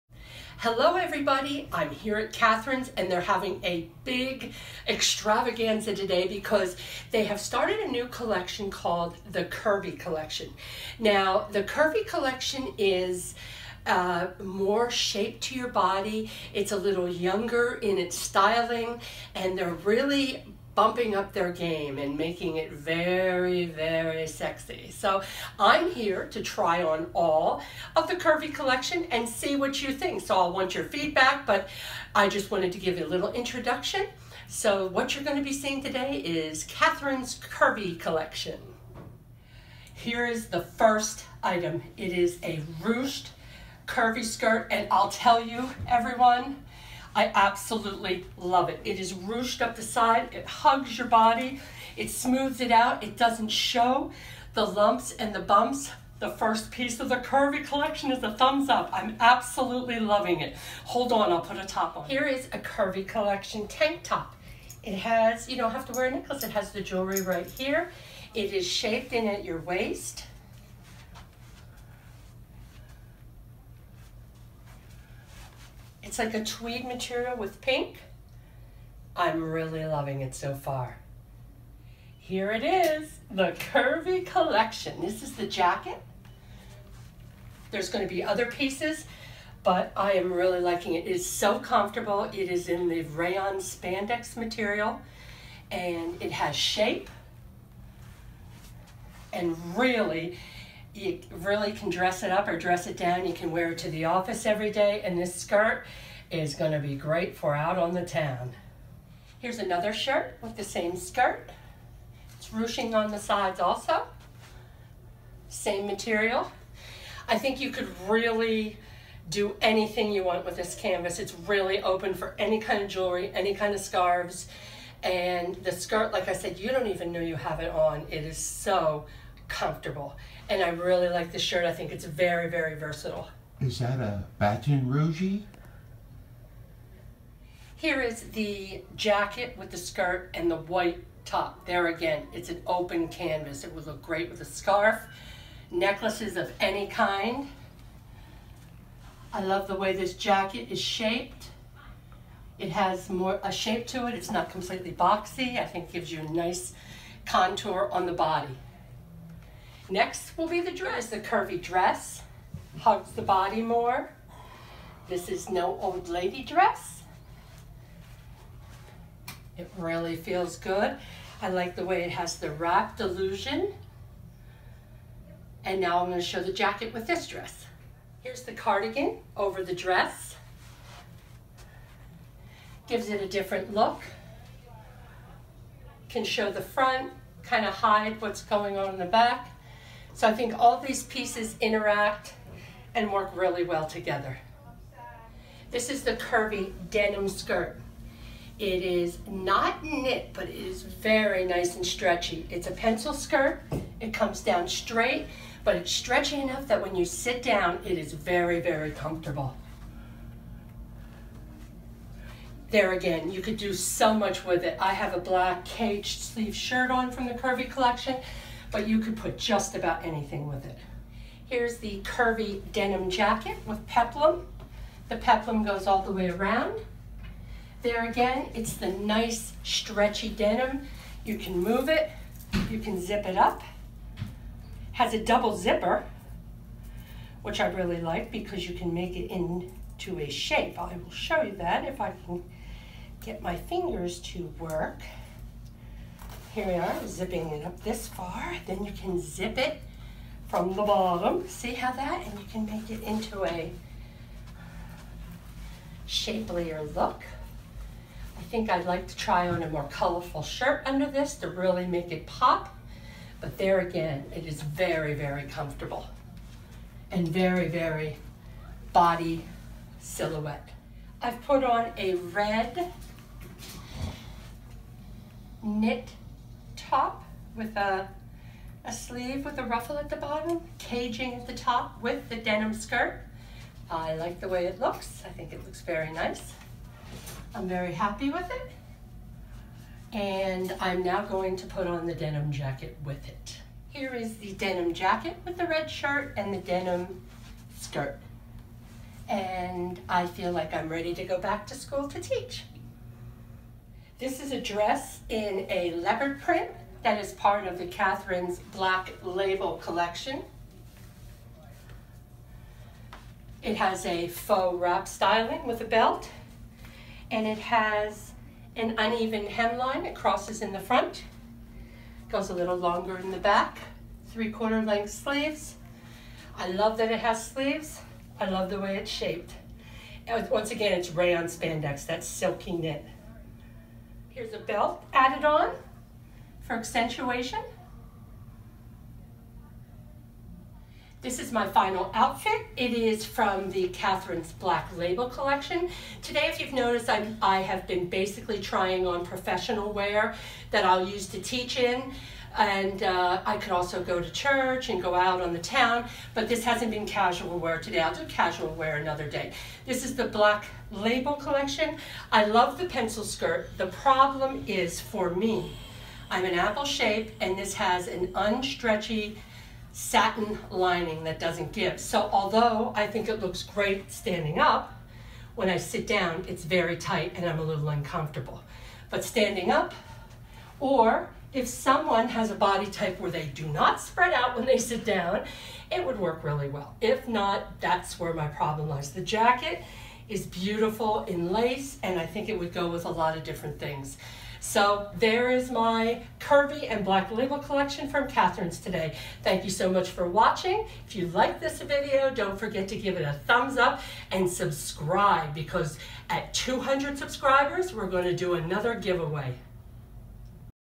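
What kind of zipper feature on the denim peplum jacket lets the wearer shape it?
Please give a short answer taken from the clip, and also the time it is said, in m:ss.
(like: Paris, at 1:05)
double zipper, at 3:55.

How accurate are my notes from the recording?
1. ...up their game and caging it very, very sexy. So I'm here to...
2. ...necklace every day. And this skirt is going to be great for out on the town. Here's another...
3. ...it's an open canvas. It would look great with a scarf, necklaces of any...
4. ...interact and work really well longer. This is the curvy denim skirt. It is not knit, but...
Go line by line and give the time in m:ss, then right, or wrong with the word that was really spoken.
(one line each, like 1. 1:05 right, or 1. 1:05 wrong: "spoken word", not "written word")
1. 0:21 wrong: "making", not "caging"
2. 1:44 wrong: "office", not "necklace"
3. 2:22 right
4. 3:11 wrong: "together", not "longer".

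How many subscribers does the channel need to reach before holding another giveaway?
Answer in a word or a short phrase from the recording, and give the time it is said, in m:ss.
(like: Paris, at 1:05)
200, at 6:46.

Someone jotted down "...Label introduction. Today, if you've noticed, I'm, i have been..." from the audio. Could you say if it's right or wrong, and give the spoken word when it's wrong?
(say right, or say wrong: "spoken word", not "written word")
wrong: "collection", not "introduction".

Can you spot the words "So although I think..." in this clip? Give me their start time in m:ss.
6:11.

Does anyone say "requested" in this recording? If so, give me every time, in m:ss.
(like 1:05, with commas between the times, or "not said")
not said.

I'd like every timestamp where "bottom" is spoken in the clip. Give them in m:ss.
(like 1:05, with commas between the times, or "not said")
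4:10, 4:40.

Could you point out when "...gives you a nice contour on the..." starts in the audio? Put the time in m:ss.
2:35.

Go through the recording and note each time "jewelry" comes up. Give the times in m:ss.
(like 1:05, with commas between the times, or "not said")
1:06, 2:02.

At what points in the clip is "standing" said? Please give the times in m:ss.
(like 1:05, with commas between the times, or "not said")
6:14, 6:19.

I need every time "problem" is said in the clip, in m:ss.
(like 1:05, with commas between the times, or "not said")
6:03, 6:28.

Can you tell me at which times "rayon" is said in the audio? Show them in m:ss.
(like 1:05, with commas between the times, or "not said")
1:33, 5:31.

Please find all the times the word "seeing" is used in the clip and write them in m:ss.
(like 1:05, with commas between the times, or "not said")
0:35.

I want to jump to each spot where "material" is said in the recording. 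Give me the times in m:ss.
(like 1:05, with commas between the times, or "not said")
1:16, 1:34, 1:55.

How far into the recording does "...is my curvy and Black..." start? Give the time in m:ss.
6:35.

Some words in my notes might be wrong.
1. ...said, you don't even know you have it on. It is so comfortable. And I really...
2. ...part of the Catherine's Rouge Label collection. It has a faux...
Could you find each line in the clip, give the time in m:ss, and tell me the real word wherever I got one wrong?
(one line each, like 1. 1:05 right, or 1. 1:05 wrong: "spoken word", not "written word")
1. 2:06 right
2. 5:07 wrong: "Black", not "Rouge".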